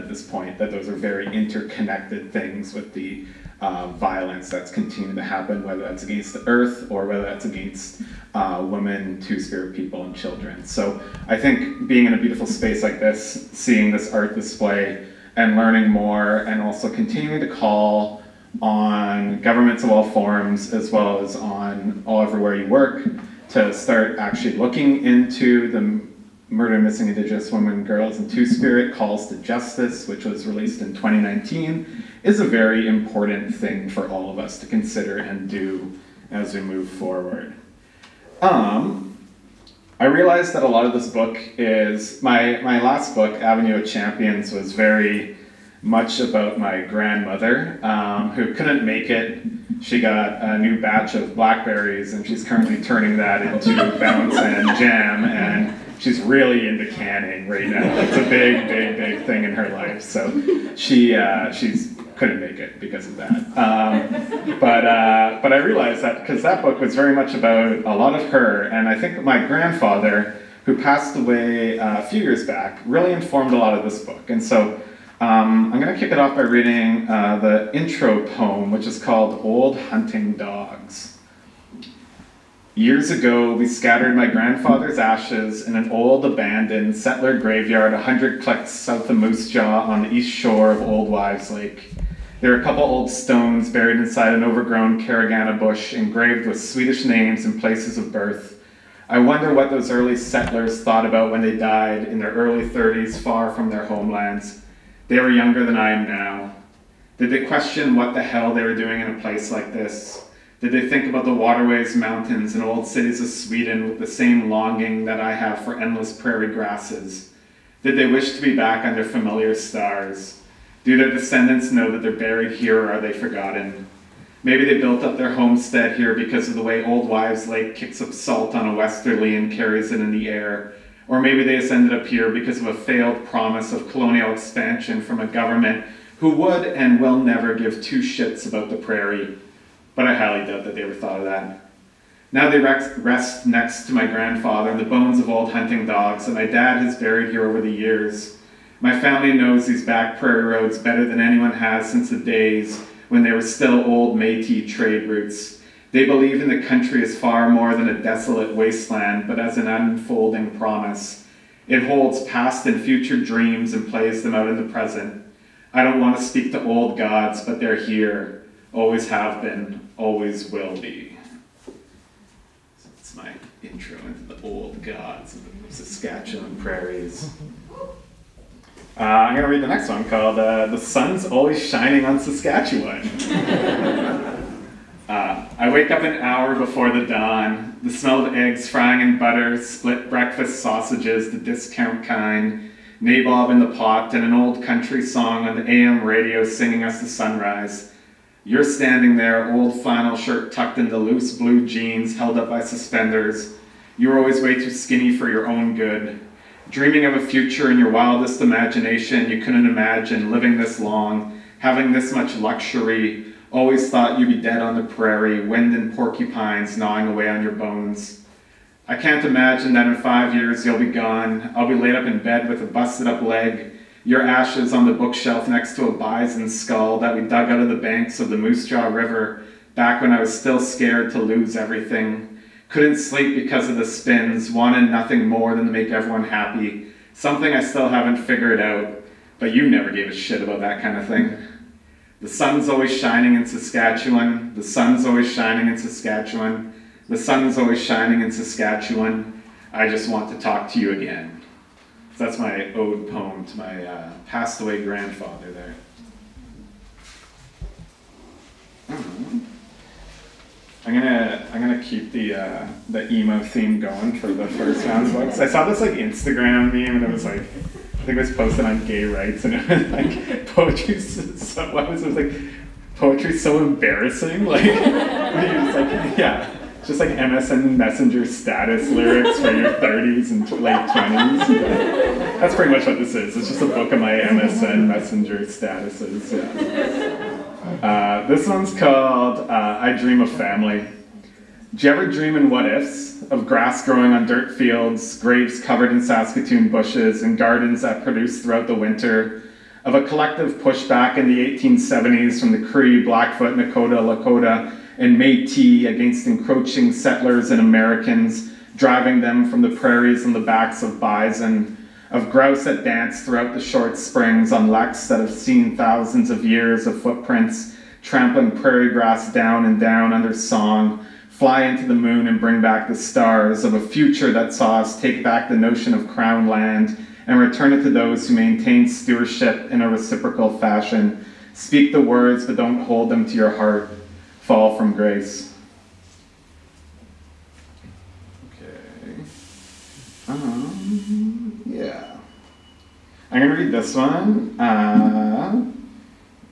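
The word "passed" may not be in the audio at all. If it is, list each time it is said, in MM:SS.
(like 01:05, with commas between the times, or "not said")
01:10, 04:14.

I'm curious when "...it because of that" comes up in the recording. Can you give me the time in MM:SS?
01:02.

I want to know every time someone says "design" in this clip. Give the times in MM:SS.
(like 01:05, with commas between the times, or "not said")
not said.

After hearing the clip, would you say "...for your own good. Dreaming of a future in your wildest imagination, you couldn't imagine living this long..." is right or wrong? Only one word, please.
right.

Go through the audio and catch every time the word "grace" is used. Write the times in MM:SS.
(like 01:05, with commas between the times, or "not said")
05:34.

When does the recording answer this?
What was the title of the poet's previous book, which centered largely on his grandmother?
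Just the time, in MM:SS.
00:43.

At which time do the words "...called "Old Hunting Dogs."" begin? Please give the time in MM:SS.
01:19.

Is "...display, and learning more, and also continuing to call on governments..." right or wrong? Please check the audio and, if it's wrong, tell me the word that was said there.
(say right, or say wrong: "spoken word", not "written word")
right.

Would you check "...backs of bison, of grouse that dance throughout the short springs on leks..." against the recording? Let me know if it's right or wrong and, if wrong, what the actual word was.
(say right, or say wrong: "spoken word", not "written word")
right.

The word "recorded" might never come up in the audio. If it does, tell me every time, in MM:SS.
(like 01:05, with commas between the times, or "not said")
not said.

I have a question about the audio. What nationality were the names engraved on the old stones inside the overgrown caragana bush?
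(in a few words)
Swedish.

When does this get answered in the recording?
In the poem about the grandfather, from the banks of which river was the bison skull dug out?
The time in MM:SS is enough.
03:48.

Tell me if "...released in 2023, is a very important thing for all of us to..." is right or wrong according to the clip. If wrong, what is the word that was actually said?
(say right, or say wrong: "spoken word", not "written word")
wrong: "2019", not "2023".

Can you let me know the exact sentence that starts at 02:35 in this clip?
They believe in the country as far more than a desolate wasteland, but as an unfolding promise.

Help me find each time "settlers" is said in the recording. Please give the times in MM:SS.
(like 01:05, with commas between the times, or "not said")
01:26, 01:40, 05:06.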